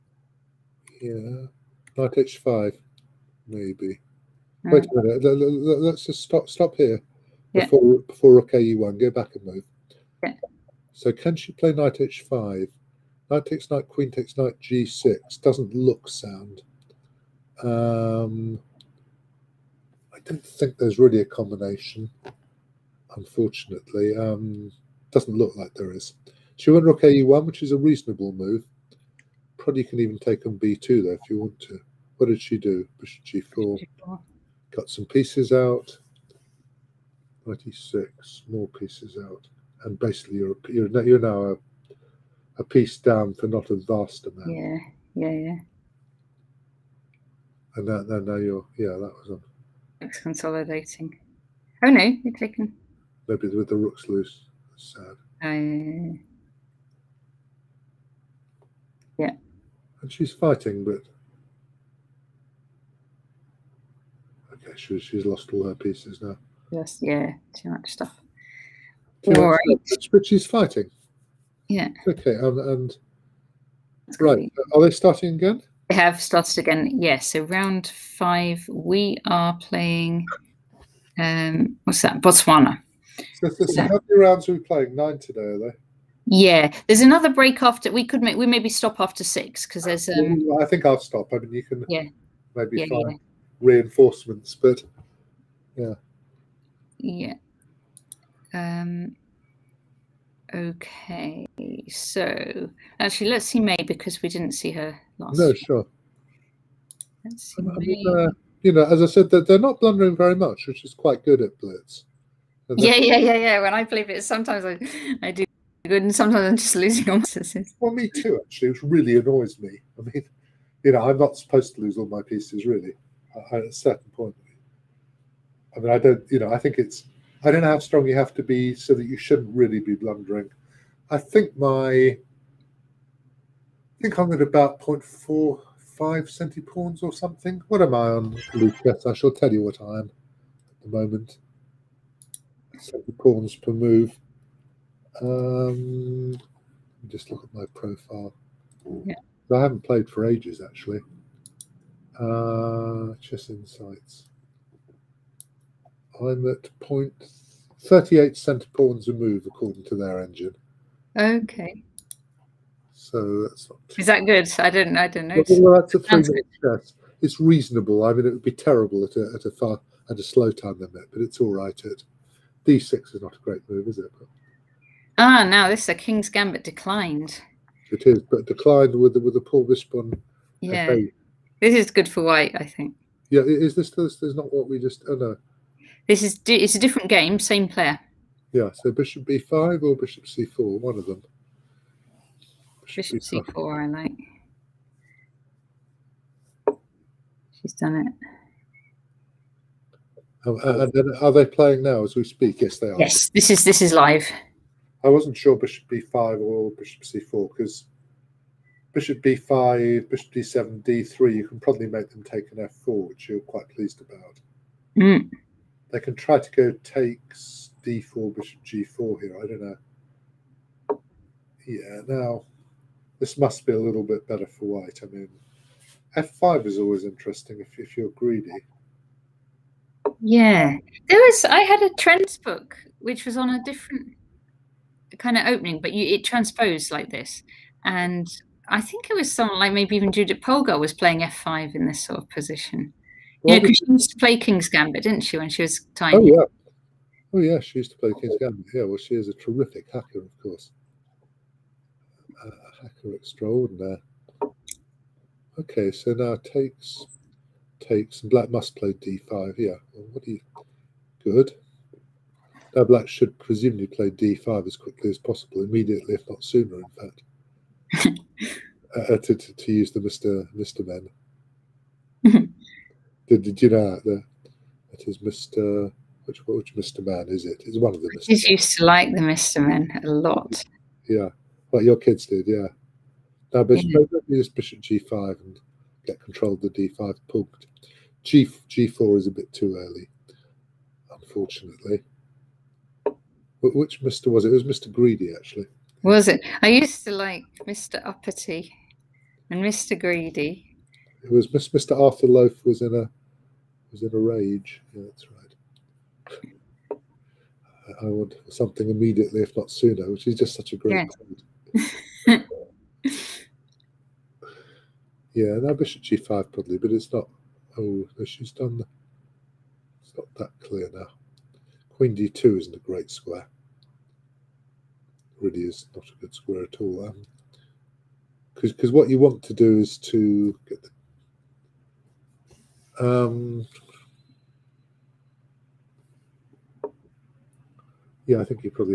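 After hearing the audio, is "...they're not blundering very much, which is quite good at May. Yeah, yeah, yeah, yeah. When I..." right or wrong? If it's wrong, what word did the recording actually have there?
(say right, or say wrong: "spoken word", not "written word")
wrong: "Blitz", not "May".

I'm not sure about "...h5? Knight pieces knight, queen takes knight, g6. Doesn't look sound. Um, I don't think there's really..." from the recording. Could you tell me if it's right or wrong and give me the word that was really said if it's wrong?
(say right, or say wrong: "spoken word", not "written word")
wrong: "takes", not "pieces".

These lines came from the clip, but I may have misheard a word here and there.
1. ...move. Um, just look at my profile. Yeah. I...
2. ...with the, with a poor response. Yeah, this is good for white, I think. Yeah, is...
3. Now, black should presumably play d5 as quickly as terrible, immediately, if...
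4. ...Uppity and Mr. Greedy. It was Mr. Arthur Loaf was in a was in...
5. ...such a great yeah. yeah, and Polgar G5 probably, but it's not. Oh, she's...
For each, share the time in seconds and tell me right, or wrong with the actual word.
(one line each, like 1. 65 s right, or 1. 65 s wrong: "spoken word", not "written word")
1. 143 s right
2. 178 s right
3. 262 s wrong: "possible", not "terrible"
4. 298 s right
5. 310 s wrong: "Bishop", not "Polgar".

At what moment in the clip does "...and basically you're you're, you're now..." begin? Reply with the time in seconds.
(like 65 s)
39 s.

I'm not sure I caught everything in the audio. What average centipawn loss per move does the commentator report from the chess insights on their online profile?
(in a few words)
0.38.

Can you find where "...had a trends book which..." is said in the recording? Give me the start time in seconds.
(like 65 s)
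231 s.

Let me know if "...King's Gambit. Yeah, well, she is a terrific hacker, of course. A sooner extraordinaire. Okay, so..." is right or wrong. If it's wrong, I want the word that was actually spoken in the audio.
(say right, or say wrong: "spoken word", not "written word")
wrong: "hacker", not "sooner".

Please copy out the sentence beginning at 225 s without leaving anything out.
I mean, f5 is always interesting if, if you're greedy.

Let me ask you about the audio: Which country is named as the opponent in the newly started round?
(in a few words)
Botswana.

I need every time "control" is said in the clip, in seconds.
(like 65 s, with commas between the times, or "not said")
286 s.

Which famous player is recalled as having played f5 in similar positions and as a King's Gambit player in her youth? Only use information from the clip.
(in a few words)
Judith Polgar.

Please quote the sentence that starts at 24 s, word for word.
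Um, doesn't look like there is.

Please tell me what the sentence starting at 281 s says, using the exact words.
Yeah, like your kids did, yeah.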